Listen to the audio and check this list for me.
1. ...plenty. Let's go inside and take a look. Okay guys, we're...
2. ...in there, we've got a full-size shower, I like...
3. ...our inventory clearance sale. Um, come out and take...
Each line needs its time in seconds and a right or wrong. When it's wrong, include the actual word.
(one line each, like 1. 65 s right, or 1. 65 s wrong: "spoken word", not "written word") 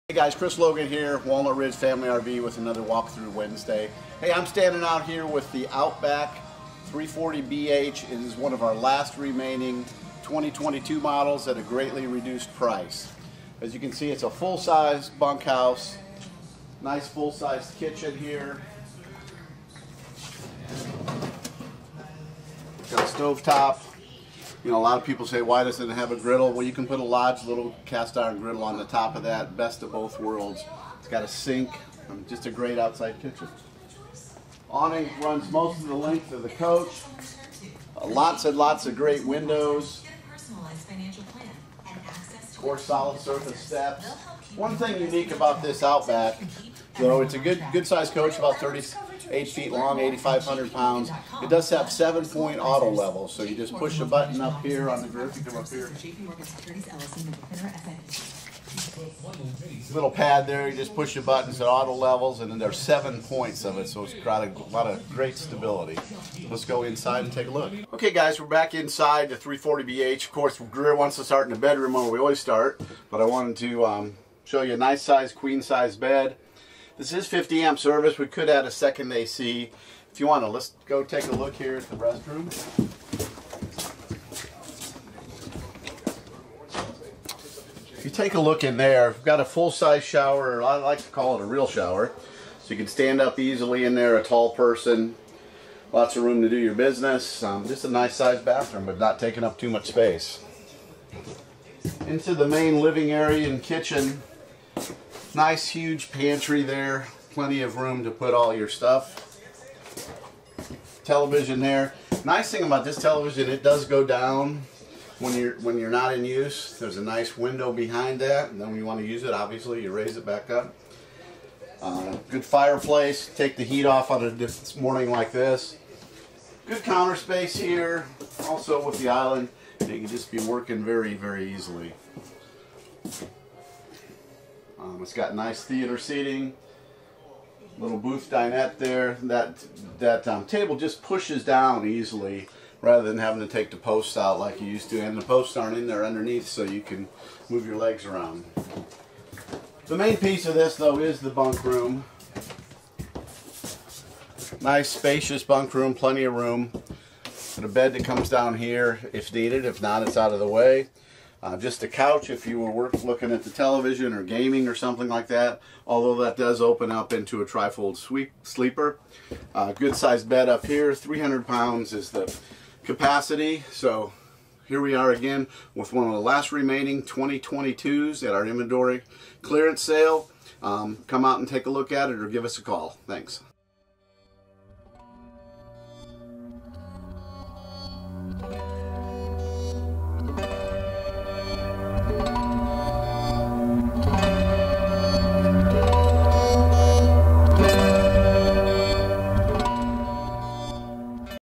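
1. 65 s wrong: "stability", not "plenty"
2. 88 s right
3. 178 s right.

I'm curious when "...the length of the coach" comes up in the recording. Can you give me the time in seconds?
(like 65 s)
35 s.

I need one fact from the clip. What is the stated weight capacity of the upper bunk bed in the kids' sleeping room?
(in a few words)
300 pounds.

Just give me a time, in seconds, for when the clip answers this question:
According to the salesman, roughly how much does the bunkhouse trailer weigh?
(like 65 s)
49 s.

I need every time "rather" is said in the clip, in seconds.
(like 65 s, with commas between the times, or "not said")
142 s.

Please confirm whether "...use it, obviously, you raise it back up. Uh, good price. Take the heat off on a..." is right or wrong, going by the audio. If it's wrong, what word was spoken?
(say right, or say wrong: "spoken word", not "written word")
wrong: "fireplace", not "price".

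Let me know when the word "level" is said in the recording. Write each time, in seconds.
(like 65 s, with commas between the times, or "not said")
52 s, 61 s.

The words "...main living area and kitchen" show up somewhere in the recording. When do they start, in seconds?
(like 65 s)
102 s.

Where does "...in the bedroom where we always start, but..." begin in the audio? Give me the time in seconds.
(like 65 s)
71 s.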